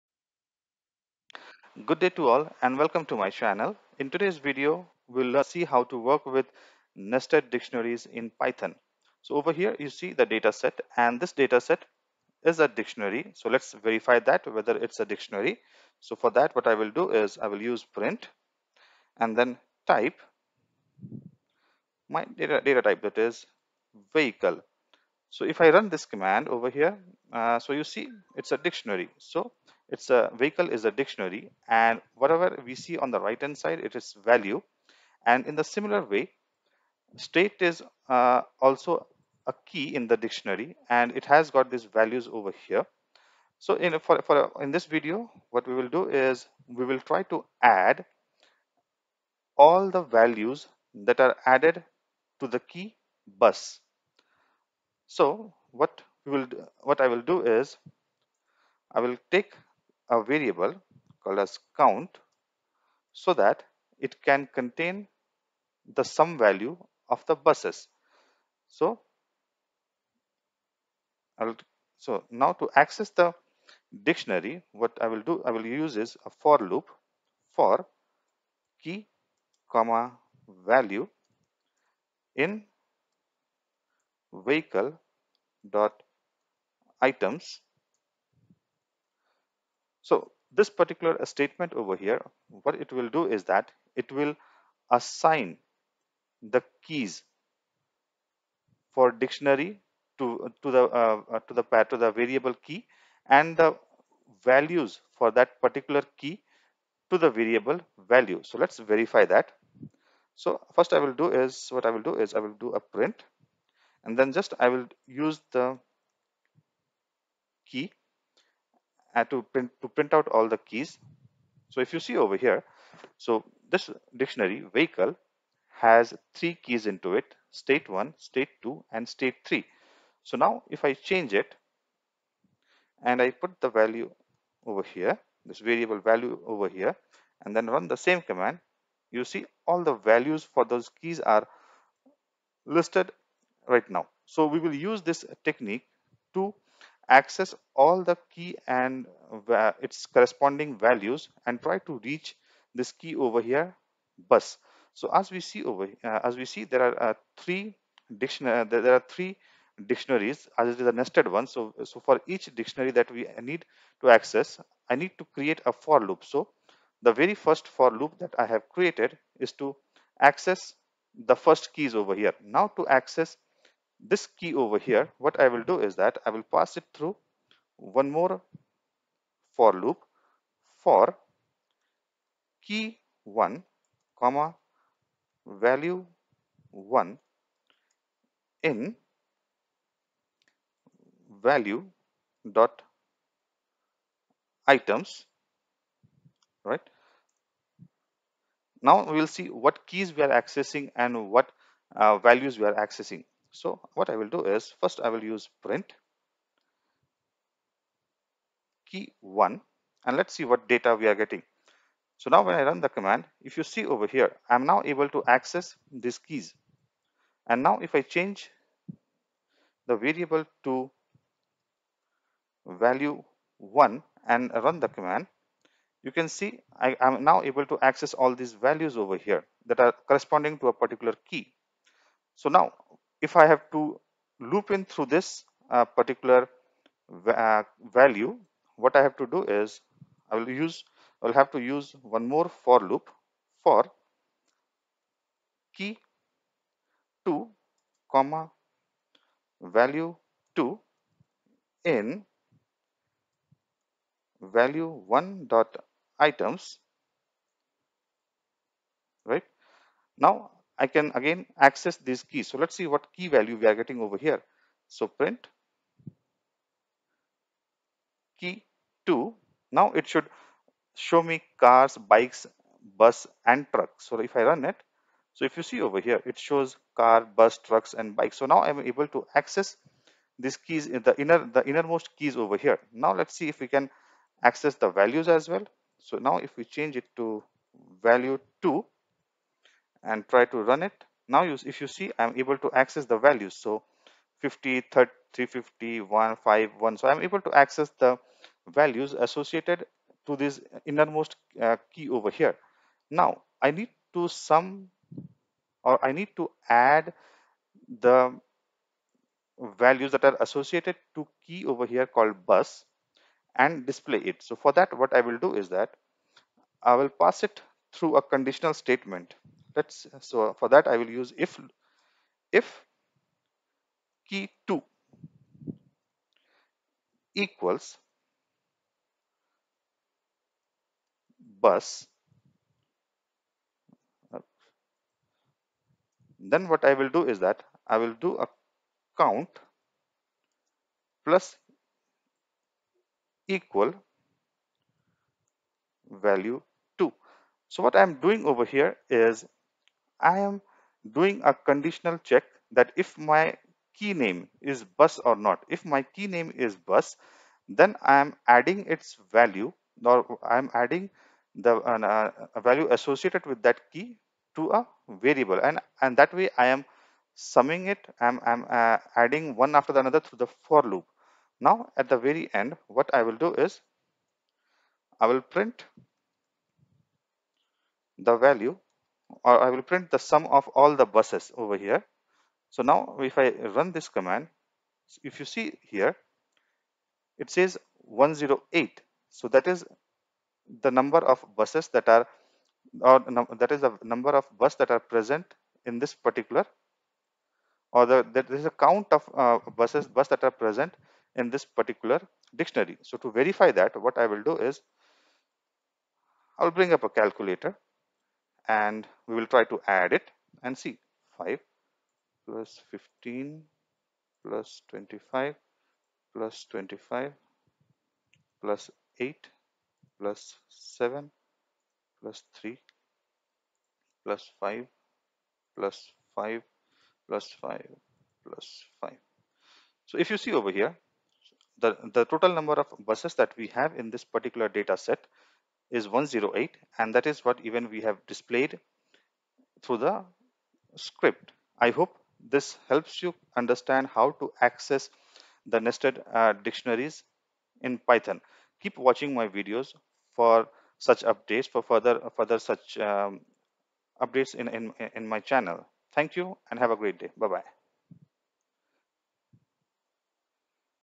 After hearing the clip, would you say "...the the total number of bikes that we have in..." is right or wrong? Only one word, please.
wrong.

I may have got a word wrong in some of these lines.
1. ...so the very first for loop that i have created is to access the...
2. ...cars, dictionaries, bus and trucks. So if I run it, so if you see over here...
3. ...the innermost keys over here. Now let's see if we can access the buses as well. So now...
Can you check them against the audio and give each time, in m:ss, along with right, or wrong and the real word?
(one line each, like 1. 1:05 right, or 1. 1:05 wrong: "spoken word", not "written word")
1. 2:46 right
2. 4:31 wrong: "bikes", not "dictionaries"
3. 4:41 wrong: "values", not "buses".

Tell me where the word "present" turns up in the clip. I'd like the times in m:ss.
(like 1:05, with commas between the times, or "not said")
6:34, 6:40.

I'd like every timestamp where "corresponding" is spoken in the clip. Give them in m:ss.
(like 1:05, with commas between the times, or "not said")
2:30, 3:50.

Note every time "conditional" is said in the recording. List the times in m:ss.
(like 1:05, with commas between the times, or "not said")
5:18, 5:51.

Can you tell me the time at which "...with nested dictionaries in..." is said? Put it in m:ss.
0:06.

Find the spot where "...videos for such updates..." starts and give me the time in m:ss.
7:29.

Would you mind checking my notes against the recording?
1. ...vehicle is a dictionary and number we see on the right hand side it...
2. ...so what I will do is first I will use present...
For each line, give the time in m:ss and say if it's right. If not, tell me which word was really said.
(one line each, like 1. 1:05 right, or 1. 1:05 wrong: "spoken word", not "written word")
1. 0:30 wrong: "whatever", not "number"
2. 3:23 wrong: "print", not "present".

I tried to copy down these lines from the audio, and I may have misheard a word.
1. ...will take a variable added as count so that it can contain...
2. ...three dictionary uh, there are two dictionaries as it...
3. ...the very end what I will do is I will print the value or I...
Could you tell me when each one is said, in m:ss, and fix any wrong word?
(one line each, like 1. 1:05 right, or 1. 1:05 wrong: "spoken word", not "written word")
1. 0:58 wrong: "called", not "added"
2. 2:37 wrong: "three", not "two"
3. 6:12 right.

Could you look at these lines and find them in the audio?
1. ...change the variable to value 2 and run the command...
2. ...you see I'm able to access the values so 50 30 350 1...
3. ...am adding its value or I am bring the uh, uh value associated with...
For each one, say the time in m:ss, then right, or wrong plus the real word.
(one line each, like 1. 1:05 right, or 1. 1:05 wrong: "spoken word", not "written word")
1. 3:38 wrong: "1", not "2"
2. 4:51 right
3. 5:58 wrong: "adding", not "bring".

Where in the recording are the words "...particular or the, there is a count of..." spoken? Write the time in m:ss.
6:36.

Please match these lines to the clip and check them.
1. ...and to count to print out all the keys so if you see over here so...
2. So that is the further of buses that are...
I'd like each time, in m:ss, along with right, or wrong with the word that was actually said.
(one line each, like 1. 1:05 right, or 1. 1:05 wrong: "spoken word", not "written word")
1. 1:59 wrong: "print", not "count"
2. 6:29 wrong: "number", not "further".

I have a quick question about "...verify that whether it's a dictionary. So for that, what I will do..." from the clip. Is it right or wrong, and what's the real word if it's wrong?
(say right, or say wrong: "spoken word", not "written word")
right.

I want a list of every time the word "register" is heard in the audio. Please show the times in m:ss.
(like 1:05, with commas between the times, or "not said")
not said.